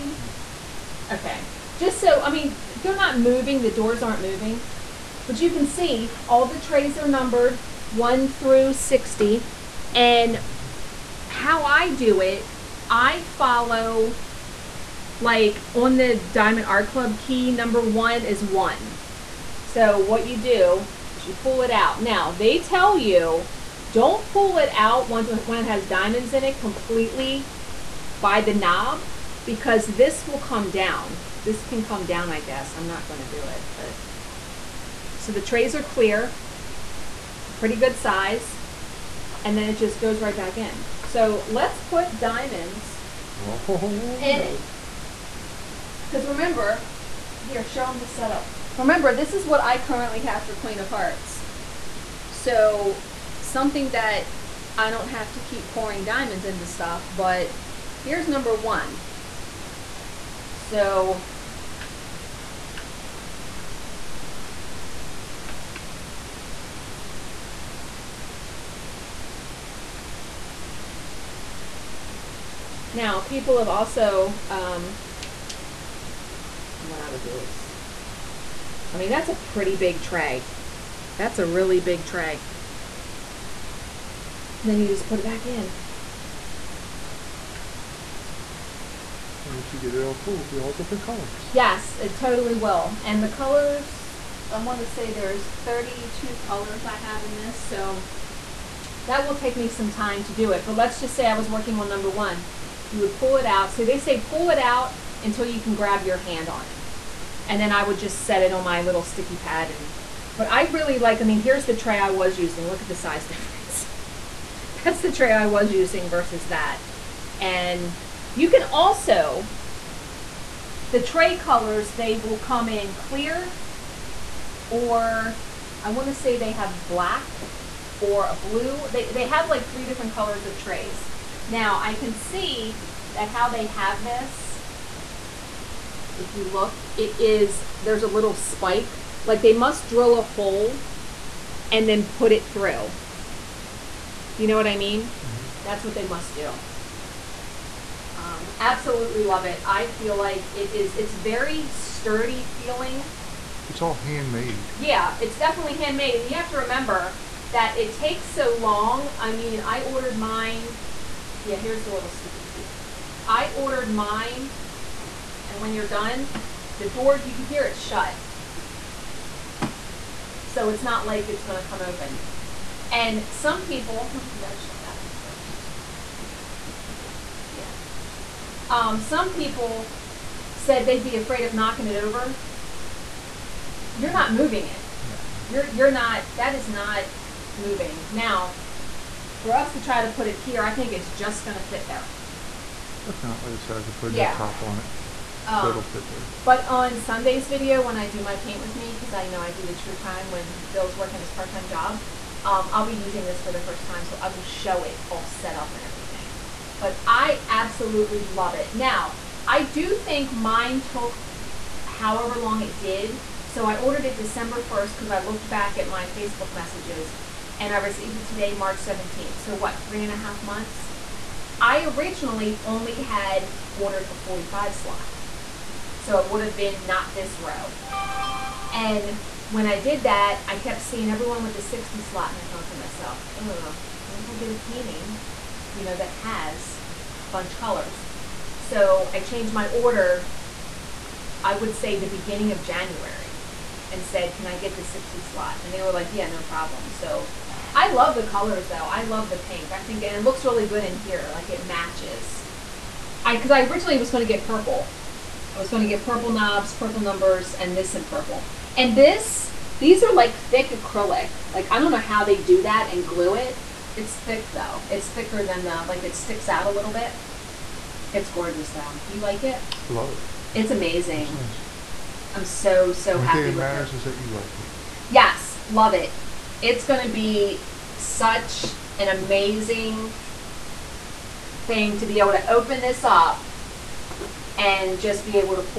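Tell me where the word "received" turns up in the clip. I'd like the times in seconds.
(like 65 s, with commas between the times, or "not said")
217 s.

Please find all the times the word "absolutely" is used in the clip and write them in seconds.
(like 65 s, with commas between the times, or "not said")
148 s, 207 s.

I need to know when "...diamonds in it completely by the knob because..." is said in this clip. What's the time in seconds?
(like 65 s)
25 s.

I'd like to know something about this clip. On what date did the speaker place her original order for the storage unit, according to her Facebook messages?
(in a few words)
December 1st.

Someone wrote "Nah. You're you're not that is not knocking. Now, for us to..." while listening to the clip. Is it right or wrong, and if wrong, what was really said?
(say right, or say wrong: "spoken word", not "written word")
wrong: "moving", not "knocking".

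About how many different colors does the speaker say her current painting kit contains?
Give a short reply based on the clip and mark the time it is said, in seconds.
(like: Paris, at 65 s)
32, at 95 s.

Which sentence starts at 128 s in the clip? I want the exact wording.
They, they have like three different colors of trays.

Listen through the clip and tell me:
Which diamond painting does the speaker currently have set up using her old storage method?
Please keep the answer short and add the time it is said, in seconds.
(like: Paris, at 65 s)
Queen of Hearts, at 50 s.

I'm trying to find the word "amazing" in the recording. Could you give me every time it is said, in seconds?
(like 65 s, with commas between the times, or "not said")
270 s, 279 s.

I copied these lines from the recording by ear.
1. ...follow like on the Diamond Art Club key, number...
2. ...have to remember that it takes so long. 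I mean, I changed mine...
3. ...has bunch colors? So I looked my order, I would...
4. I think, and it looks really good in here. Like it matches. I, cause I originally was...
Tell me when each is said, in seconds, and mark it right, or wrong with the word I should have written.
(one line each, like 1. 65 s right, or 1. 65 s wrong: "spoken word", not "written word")
1. 13 s right
2. 156 s wrong: "ordered", not "changed"
3. 236 s wrong: "changed", not "looked"
4. 249 s right.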